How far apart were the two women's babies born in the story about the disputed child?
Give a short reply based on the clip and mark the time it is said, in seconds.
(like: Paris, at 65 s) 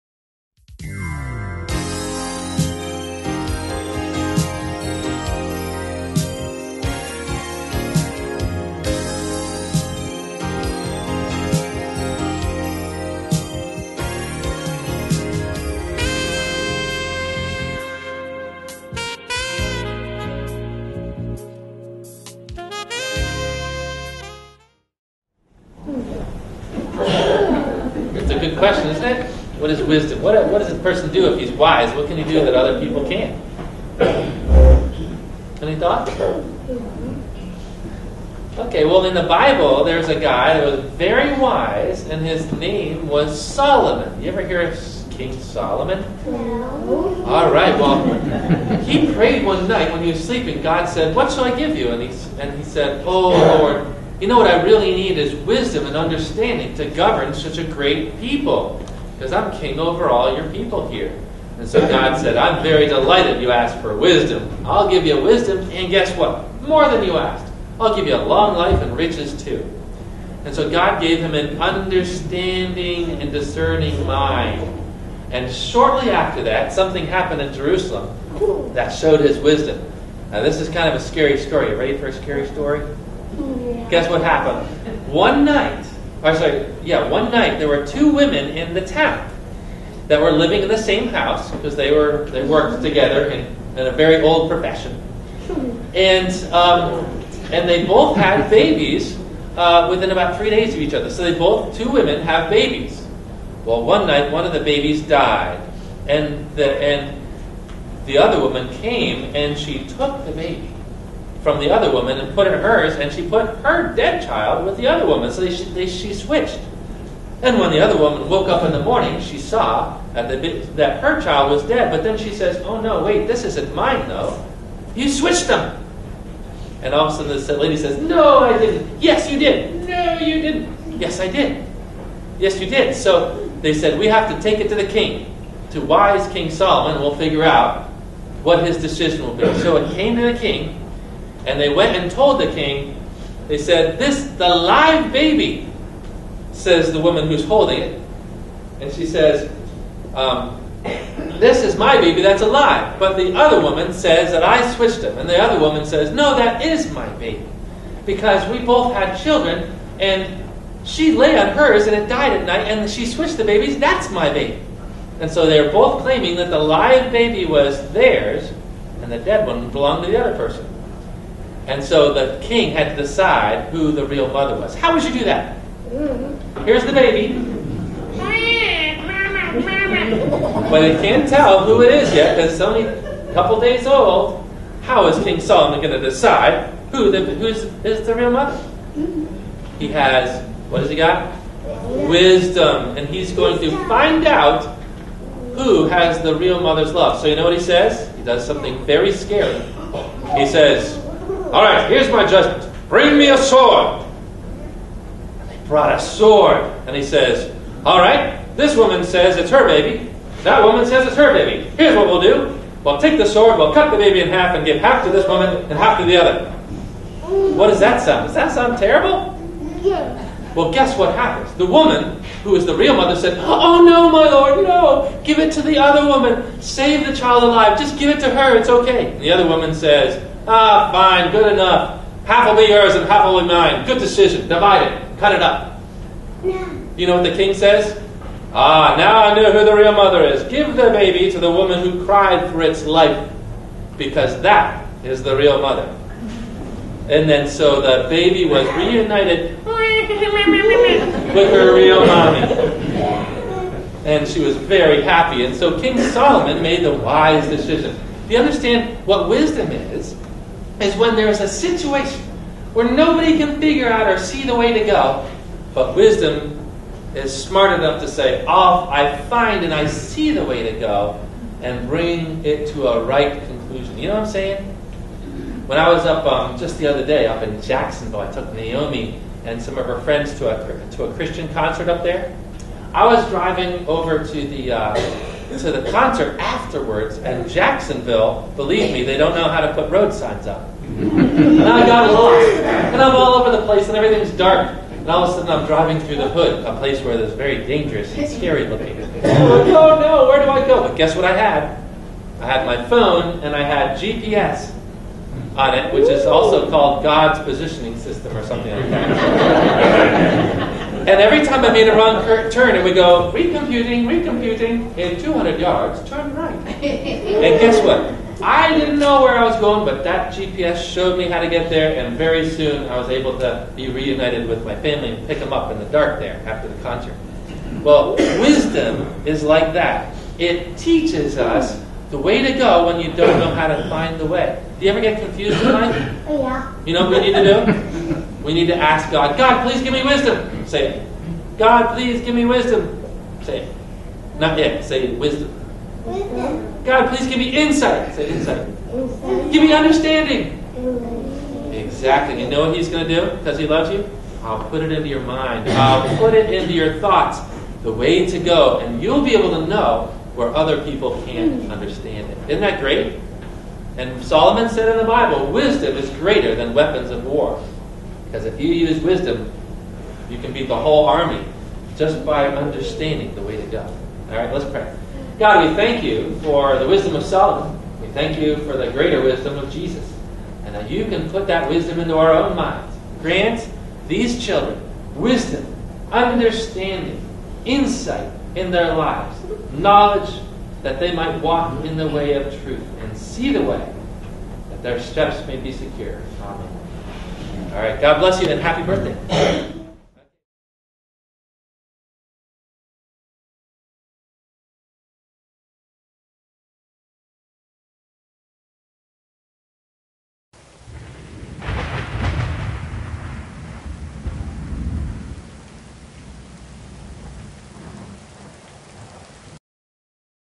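About three days, at 99 s.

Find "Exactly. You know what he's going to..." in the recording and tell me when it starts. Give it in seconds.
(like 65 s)
351 s.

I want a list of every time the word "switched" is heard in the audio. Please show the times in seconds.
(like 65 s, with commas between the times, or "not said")
116 s, 125 s, 154 s, 163 s.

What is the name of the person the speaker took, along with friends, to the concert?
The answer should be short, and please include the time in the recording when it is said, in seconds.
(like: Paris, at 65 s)
Naomi, at 278 s.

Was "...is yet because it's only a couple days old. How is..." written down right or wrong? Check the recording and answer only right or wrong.
right.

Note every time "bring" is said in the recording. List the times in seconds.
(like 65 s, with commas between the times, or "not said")
202 s, 271 s.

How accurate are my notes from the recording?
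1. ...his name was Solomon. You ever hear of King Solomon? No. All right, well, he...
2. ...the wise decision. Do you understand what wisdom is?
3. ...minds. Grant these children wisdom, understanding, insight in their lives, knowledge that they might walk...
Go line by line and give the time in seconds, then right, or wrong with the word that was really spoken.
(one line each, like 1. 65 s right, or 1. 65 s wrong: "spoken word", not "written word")
1. 42 s right
2. 256 s right
3. 382 s right.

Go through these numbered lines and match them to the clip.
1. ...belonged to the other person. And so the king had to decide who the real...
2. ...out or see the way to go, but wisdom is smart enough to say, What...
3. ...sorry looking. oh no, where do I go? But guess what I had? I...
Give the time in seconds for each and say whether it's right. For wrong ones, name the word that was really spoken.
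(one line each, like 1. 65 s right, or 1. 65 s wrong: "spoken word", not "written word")
1. 169 s right
2. 263 s wrong: "Off", not "What"
3. 298 s wrong: "scary", not "sorry".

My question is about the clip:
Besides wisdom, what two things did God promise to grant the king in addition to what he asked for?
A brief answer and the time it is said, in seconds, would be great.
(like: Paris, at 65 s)
Long life and riches, at 68 s.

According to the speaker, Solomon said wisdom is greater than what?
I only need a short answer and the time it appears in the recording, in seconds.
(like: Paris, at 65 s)
Weapons of war, at 366 s.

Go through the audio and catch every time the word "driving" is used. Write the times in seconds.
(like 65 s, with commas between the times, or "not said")
283 s, 295 s.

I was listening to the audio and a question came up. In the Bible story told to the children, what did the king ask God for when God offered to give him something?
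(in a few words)
Wisdom and understanding.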